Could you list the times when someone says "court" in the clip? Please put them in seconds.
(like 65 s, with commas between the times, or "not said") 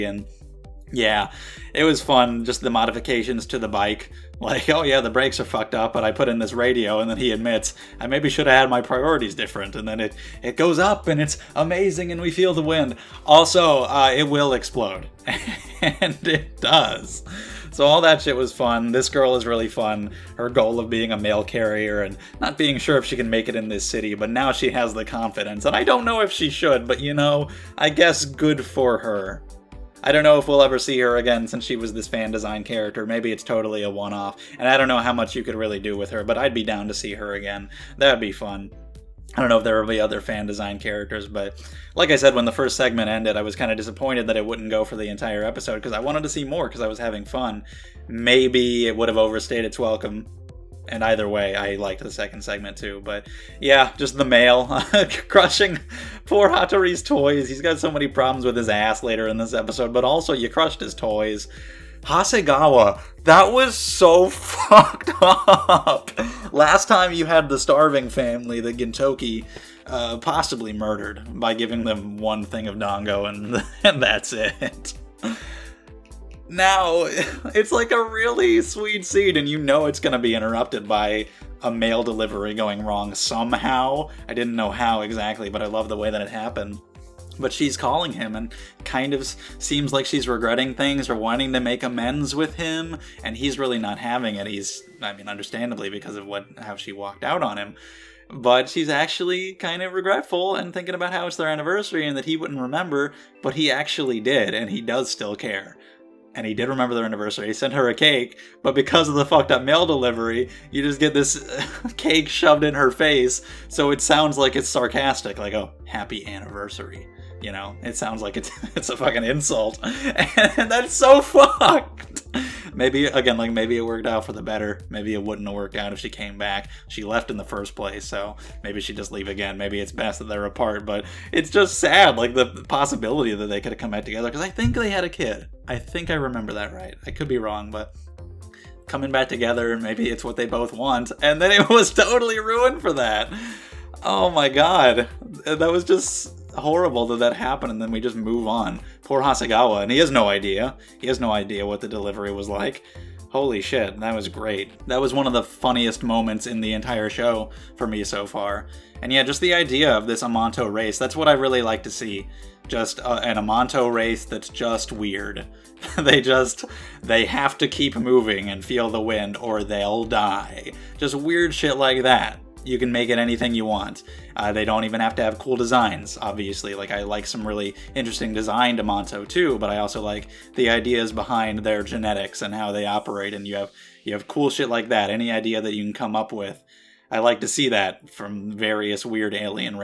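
not said.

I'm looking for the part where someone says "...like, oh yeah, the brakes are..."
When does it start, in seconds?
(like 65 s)
4 s.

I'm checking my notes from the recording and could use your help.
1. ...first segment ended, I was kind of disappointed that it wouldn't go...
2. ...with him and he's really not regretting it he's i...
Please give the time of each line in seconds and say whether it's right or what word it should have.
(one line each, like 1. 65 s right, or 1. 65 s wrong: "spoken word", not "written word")
1. 42 s right
2. 92 s wrong: "having", not "regretting".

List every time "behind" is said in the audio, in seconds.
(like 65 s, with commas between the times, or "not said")
181 s.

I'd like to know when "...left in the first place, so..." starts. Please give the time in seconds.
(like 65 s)
127 s.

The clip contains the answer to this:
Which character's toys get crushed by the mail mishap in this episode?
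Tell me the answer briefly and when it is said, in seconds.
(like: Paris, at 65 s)
Hattori, at 56 s.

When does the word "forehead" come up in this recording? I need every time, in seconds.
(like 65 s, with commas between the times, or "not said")
not said.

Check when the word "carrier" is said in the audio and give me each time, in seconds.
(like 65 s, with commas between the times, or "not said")
21 s.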